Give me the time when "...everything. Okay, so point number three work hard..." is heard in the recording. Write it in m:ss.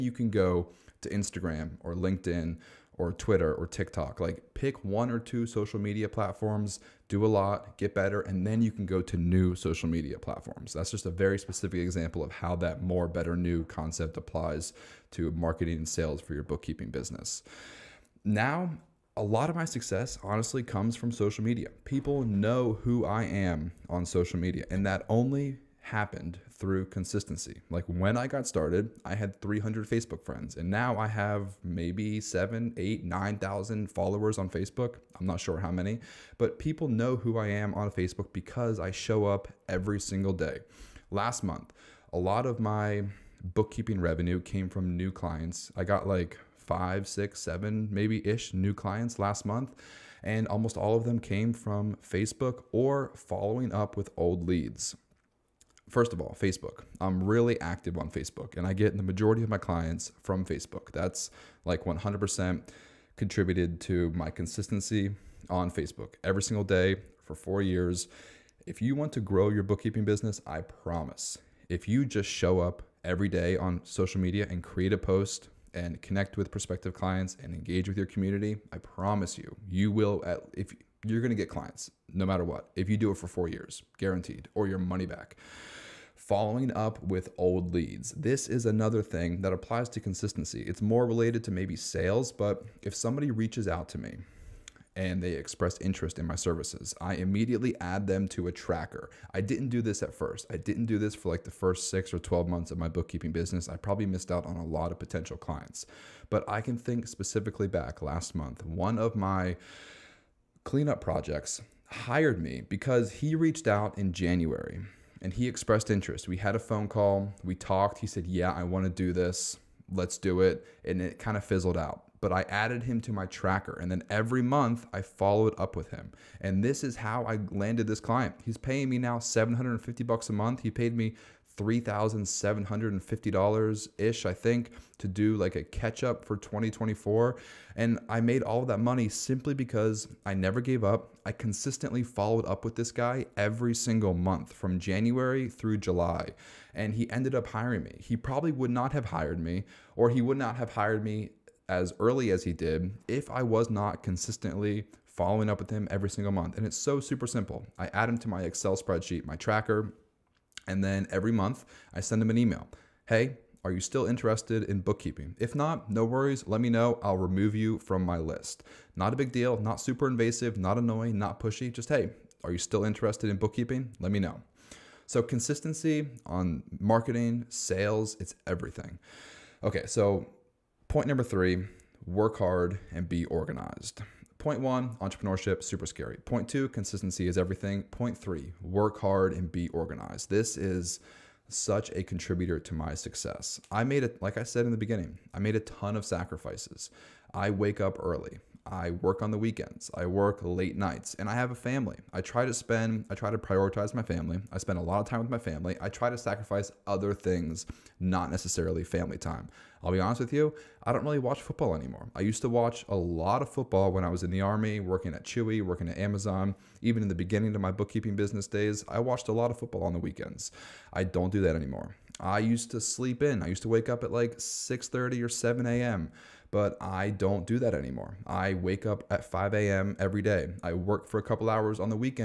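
2:58.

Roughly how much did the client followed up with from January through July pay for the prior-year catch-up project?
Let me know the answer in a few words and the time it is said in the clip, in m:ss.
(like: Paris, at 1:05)
$3,750, at 2:11.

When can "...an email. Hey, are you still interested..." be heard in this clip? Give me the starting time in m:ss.
2:42.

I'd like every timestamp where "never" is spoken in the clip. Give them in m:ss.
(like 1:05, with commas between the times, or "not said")
2:20.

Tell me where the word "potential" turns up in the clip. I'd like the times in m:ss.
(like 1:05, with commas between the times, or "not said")
1:44.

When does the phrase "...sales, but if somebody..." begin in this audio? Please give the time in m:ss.
1:31.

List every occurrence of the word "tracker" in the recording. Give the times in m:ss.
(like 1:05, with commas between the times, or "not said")
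1:38, 2:03, 2:39.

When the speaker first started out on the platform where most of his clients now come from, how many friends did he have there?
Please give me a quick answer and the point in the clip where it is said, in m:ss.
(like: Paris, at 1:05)
300, at 0:29.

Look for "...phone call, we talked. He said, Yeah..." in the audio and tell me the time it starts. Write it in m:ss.
1:56.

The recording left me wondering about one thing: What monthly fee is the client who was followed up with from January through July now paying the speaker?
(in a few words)
$750.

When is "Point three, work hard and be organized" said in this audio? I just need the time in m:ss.
3:07.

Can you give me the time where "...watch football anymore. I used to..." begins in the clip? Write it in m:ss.
3:31.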